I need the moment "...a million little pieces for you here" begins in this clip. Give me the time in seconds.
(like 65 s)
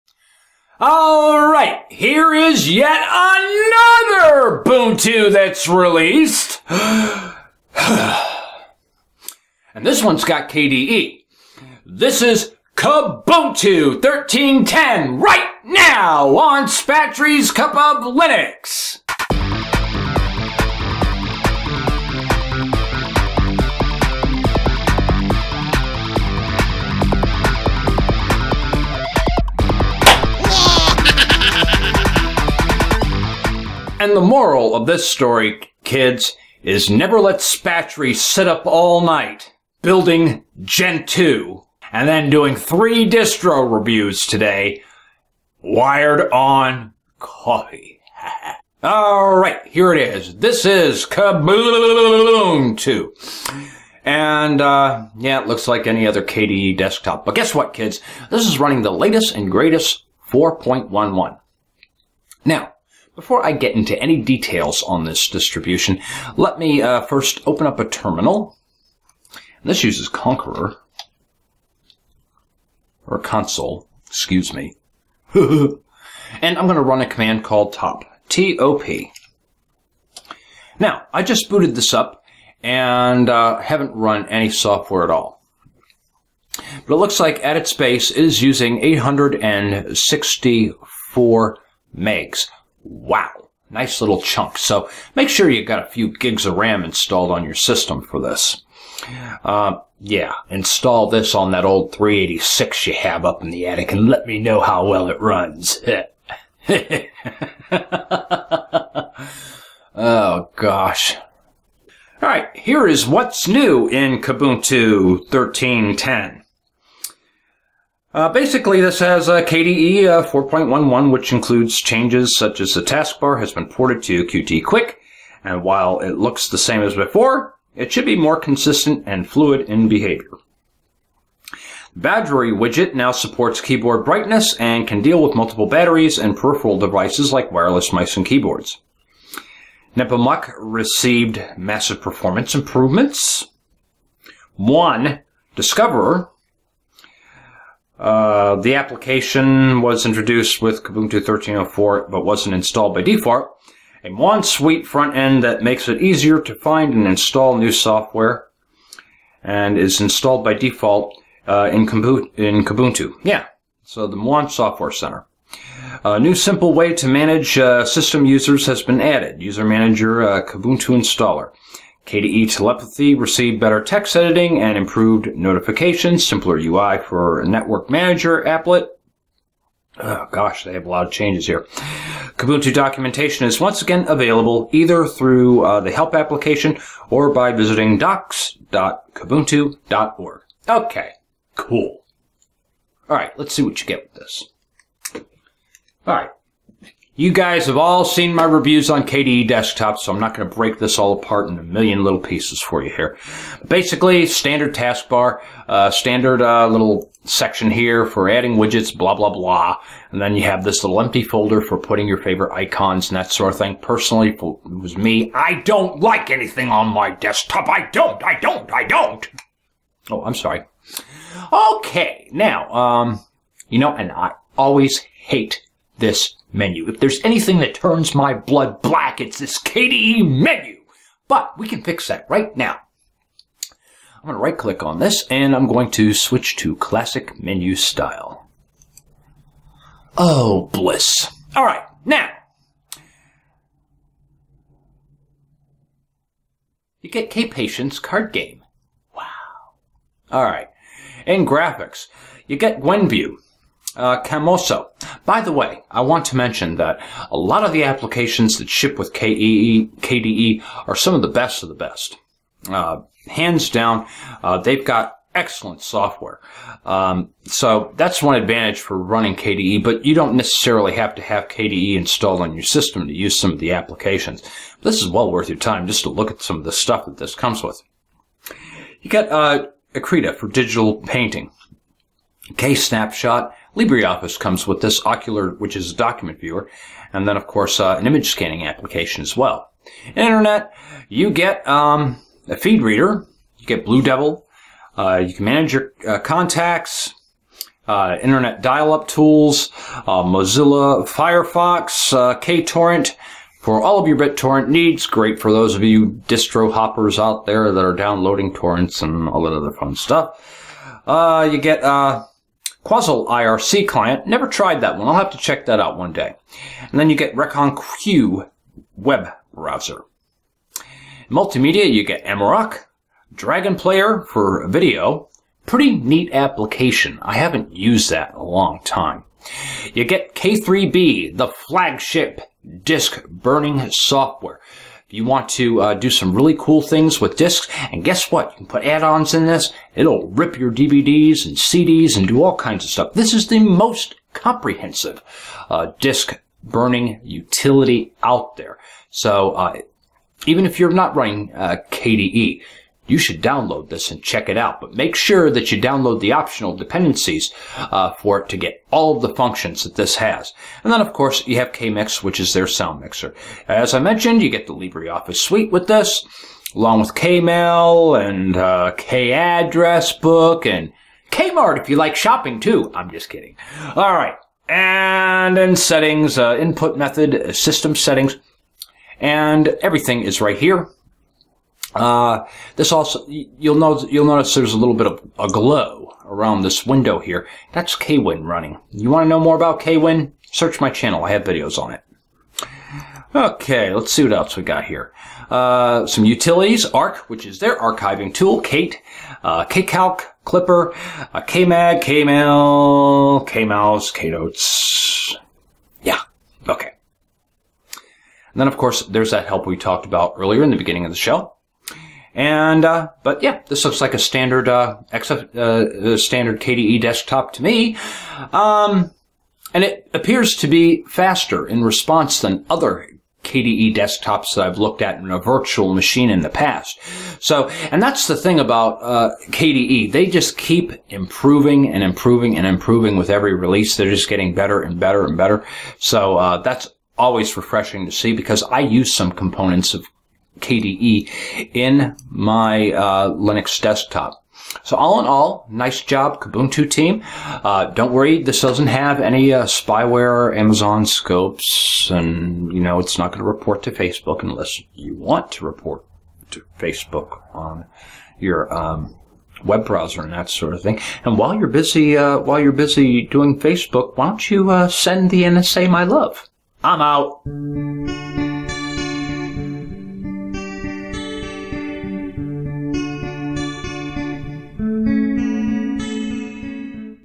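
201 s.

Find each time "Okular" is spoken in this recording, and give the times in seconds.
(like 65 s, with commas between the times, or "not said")
285 s.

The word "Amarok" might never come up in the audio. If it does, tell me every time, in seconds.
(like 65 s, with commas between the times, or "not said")
322 s.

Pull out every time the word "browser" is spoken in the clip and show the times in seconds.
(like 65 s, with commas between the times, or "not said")
319 s, 459 s.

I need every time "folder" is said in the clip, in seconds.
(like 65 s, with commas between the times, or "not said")
211 s.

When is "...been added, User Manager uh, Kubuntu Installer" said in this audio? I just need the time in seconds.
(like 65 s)
168 s.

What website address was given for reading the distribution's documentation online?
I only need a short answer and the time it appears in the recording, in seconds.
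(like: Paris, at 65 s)
docs.kubuntu.org, at 187 s.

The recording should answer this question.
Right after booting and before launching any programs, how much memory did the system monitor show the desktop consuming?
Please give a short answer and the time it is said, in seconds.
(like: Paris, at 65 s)
864 megs, at 88 s.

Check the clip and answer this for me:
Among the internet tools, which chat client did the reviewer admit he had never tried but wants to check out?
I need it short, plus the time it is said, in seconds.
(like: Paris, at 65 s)
Quassel, at 312 s.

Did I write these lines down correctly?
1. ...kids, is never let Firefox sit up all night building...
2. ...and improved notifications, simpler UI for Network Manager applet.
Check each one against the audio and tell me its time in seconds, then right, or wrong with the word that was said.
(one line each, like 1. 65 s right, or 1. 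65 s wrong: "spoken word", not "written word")
1. 35 s wrong: "Spatry", not "Firefox"
2. 174 s right.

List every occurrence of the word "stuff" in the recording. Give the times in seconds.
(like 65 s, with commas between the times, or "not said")
276 s, 309 s, 342 s.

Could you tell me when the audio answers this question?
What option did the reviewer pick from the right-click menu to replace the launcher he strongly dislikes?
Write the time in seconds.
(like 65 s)
236 s.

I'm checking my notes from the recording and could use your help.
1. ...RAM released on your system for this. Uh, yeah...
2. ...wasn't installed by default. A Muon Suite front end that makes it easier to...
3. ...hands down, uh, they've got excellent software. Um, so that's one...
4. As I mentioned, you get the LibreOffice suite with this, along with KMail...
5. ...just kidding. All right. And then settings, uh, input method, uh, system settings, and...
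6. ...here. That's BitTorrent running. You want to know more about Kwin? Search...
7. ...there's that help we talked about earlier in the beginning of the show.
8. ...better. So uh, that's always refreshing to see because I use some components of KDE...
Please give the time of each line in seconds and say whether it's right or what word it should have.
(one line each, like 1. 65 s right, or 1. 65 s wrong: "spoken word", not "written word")
1. 96 s wrong: "installed", not "released"
2. 152 s right
3. 263 s right
4. 363 s right
5. 373 s right
6. 387 s wrong: "Kwin", not "BitTorrent"
7. 409 s right
8. 435 s right.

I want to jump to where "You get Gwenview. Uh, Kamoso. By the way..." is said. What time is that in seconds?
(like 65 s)
252 s.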